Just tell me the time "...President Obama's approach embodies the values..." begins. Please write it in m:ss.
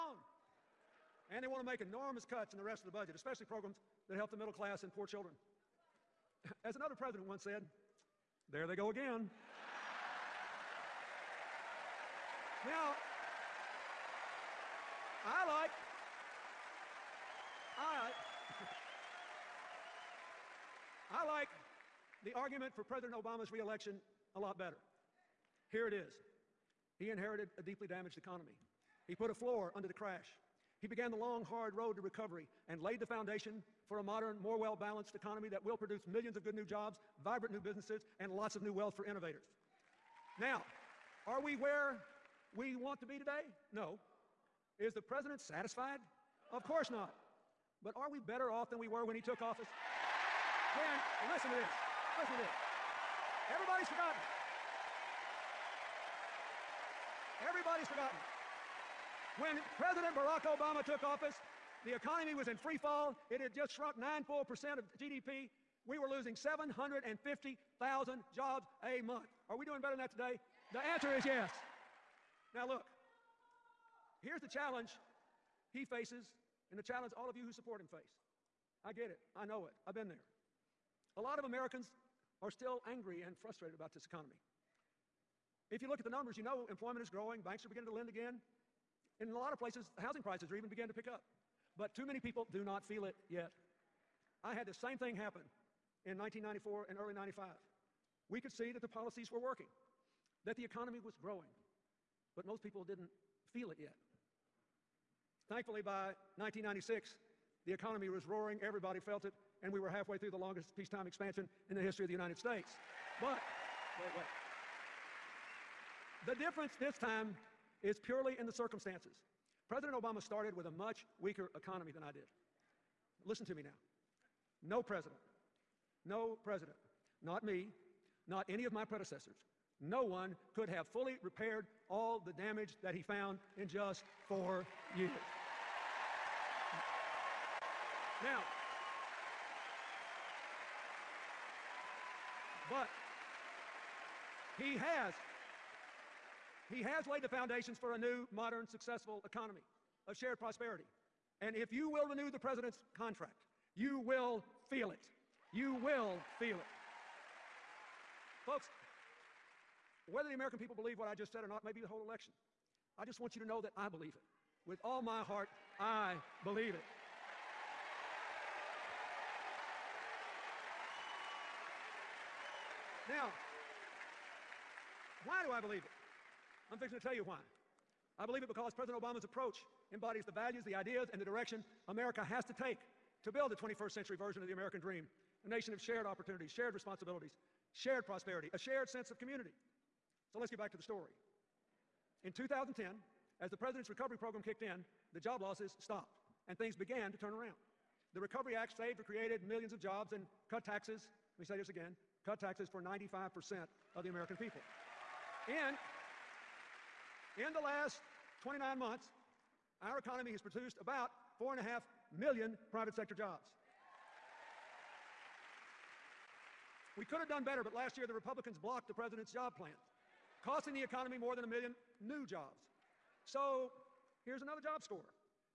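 2:58.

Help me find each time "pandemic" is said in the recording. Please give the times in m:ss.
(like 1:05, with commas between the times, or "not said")
not said.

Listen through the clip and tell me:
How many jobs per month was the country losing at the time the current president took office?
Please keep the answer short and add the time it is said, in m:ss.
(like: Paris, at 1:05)
750,000, at 1:06.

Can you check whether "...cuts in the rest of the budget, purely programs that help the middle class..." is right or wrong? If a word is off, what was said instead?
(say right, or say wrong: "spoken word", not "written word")
wrong: "especially", not "purely".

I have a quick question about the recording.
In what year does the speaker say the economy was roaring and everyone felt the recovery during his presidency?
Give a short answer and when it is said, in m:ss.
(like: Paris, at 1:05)
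1996, at 1:46.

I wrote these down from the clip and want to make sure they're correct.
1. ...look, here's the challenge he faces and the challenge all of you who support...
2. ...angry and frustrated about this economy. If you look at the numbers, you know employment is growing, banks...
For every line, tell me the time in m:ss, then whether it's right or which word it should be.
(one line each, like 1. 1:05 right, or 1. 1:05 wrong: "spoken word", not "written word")
1. 1:12 right
2. 1:22 right.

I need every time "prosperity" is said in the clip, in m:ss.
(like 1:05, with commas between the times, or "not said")
2:30, 3:08.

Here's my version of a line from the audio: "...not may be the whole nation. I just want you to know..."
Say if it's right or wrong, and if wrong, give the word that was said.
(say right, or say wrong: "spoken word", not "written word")
wrong: "election", not "nation".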